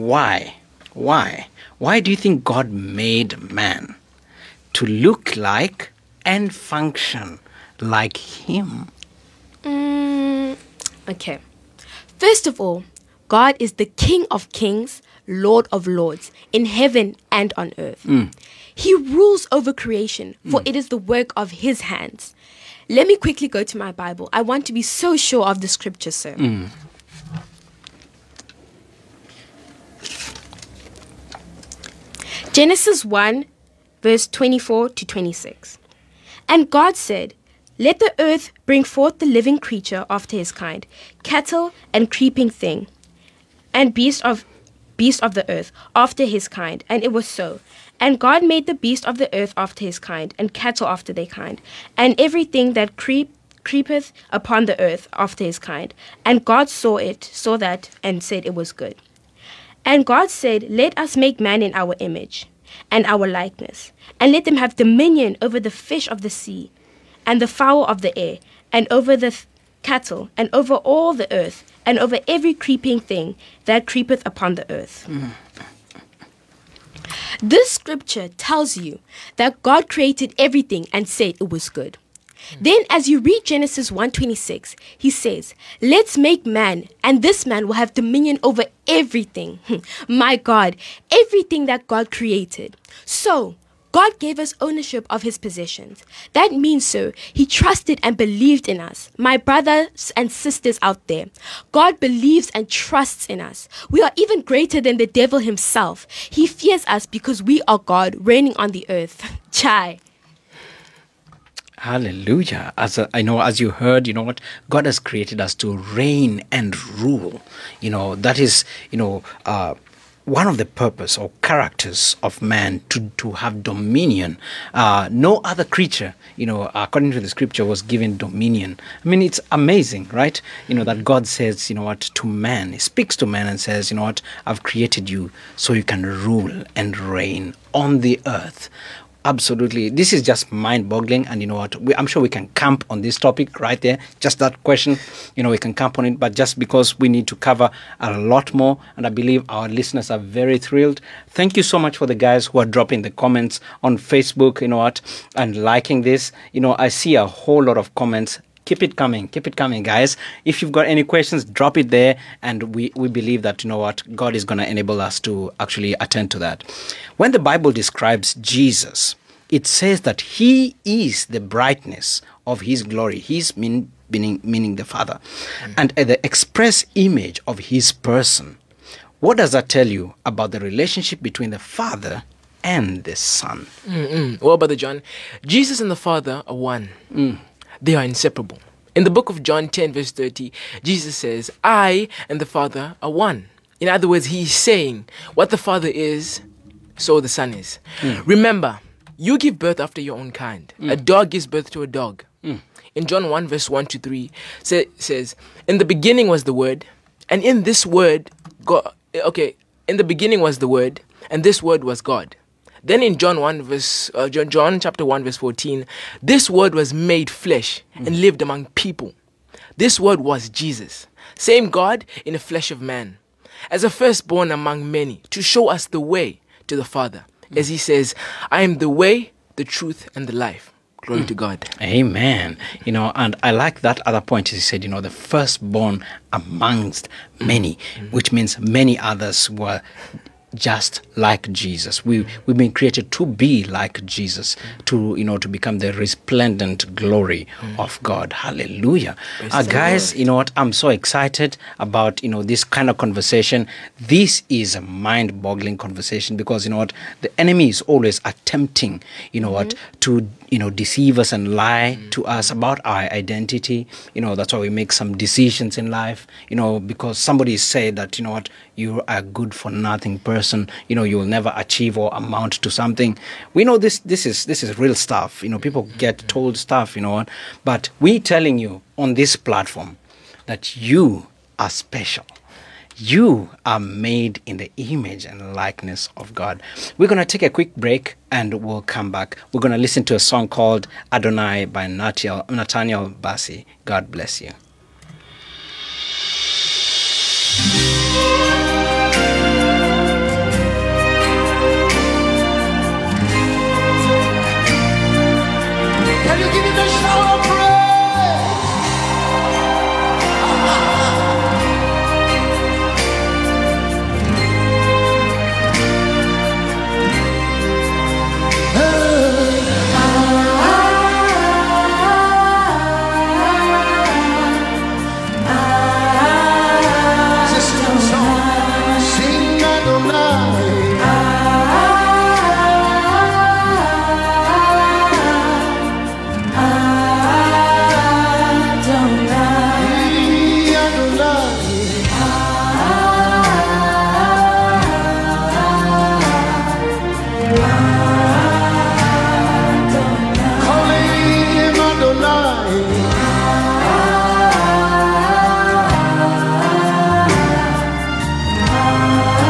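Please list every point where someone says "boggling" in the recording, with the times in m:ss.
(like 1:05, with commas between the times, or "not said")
2:20, 4:15.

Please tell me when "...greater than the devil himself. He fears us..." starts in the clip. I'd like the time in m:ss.
1:44.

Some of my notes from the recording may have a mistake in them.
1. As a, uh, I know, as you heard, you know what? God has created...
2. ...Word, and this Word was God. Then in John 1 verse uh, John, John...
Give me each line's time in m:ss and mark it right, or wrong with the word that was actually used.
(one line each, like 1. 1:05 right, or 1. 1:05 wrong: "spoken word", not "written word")
1. 1:52 right
2. 3:30 right.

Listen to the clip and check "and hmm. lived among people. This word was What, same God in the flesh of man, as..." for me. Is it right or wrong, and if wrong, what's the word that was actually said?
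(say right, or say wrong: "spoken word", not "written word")
wrong: "Jesus", not "What".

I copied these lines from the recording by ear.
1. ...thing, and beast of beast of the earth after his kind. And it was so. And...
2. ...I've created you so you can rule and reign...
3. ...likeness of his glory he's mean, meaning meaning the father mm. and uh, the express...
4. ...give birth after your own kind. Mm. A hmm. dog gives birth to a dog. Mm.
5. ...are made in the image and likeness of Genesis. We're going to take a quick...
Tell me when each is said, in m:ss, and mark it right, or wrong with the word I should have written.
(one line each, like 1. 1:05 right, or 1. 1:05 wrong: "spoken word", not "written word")
1. 0:42 right
2. 2:14 right
3. 2:51 wrong: "brightness", not "likeness"
4. 3:19 right
5. 4:43 wrong: "God", not "Genesis".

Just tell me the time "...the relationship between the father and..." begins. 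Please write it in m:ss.
3:00.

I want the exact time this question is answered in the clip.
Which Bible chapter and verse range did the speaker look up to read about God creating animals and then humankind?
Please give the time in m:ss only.
0:32.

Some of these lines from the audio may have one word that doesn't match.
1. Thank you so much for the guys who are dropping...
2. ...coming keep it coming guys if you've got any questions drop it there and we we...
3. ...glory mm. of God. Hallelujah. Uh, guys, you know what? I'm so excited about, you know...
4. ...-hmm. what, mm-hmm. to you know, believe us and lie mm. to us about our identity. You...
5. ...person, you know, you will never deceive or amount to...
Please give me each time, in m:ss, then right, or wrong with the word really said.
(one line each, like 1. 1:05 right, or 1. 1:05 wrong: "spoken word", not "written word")
1. 2:31 right
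2. 2:38 right
3. 4:06 right
4. 4:19 wrong: "deceive", not "believe"
5. 4:30 wrong: "achieve", not "deceive".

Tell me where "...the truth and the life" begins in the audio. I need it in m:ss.
3:49.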